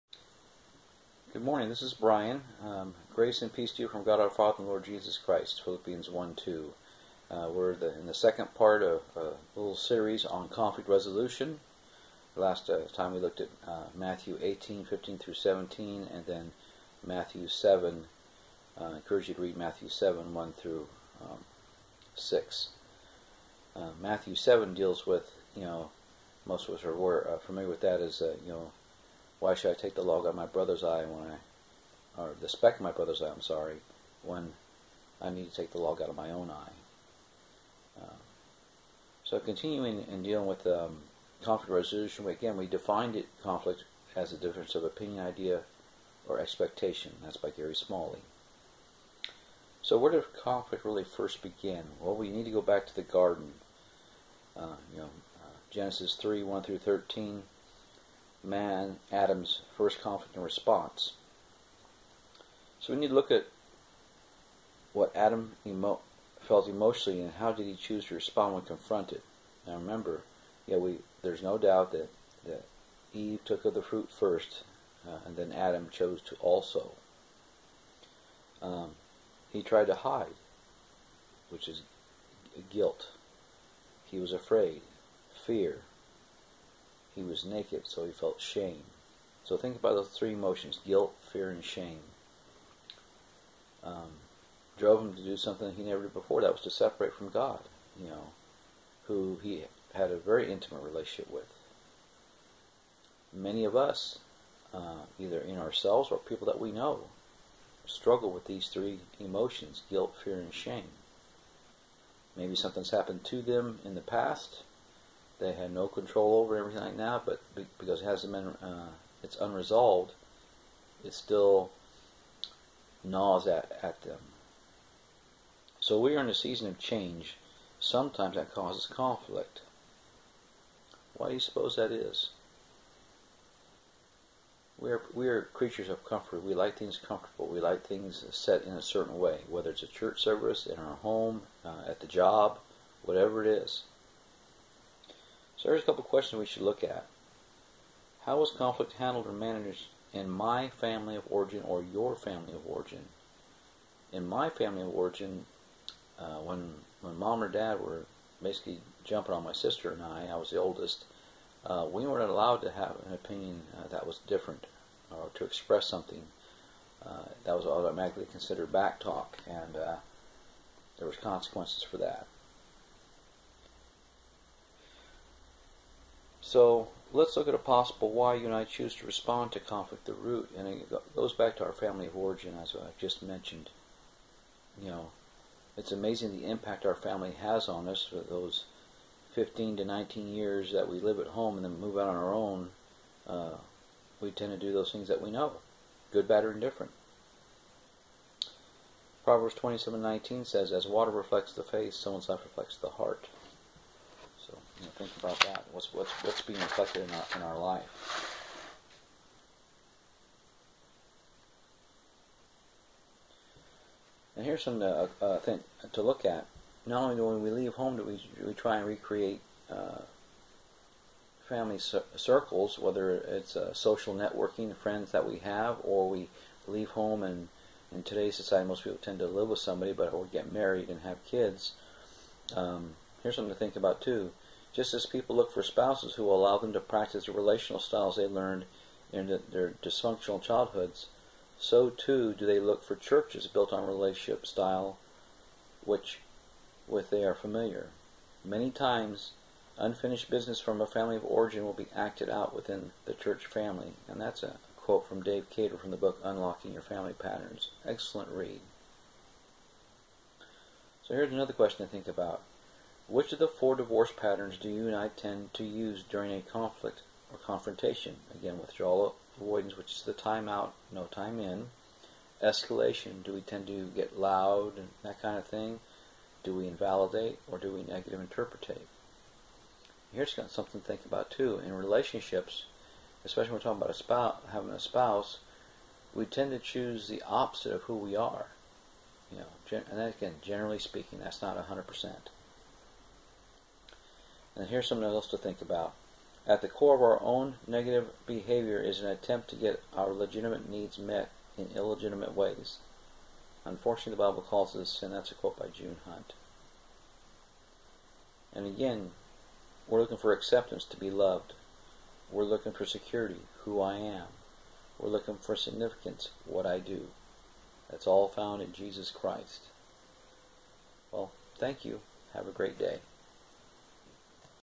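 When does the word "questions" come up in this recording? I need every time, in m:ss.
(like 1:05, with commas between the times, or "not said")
2:26, 4:21.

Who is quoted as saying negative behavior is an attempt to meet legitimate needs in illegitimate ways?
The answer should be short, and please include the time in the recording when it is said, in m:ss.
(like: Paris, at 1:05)
June Hunt, at 5:05.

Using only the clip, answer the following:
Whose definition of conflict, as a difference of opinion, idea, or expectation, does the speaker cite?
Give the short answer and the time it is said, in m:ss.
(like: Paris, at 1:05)
Gary Smalley, at 0:47.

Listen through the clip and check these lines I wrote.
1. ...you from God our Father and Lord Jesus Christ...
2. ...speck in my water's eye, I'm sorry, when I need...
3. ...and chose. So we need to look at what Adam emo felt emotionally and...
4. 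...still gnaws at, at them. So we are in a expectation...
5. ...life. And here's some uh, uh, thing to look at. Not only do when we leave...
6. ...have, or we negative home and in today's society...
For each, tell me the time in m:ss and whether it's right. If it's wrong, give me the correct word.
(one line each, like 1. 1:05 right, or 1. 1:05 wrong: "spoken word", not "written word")
1. 0:03 right
2. 0:32 wrong: "brother", not "water"
3. 1:00 wrong: "response", not "chose"
4. 2:01 wrong: "season", not "expectation"
5. 3:27 right
6. 3:45 wrong: "leave", not "negative".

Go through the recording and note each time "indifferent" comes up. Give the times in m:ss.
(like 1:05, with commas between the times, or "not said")
3:16.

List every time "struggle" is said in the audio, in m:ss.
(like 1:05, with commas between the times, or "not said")
1:47.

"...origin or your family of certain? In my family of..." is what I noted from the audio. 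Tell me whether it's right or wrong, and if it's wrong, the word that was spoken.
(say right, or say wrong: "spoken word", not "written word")
wrong: "origin", not "certain".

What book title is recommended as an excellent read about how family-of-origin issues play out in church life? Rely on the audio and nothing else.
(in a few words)
Unlocking Your Family Patterns.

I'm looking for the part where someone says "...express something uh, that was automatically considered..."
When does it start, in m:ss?
2:45.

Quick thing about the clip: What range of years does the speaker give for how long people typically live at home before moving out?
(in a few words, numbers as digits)
15 to 19 years.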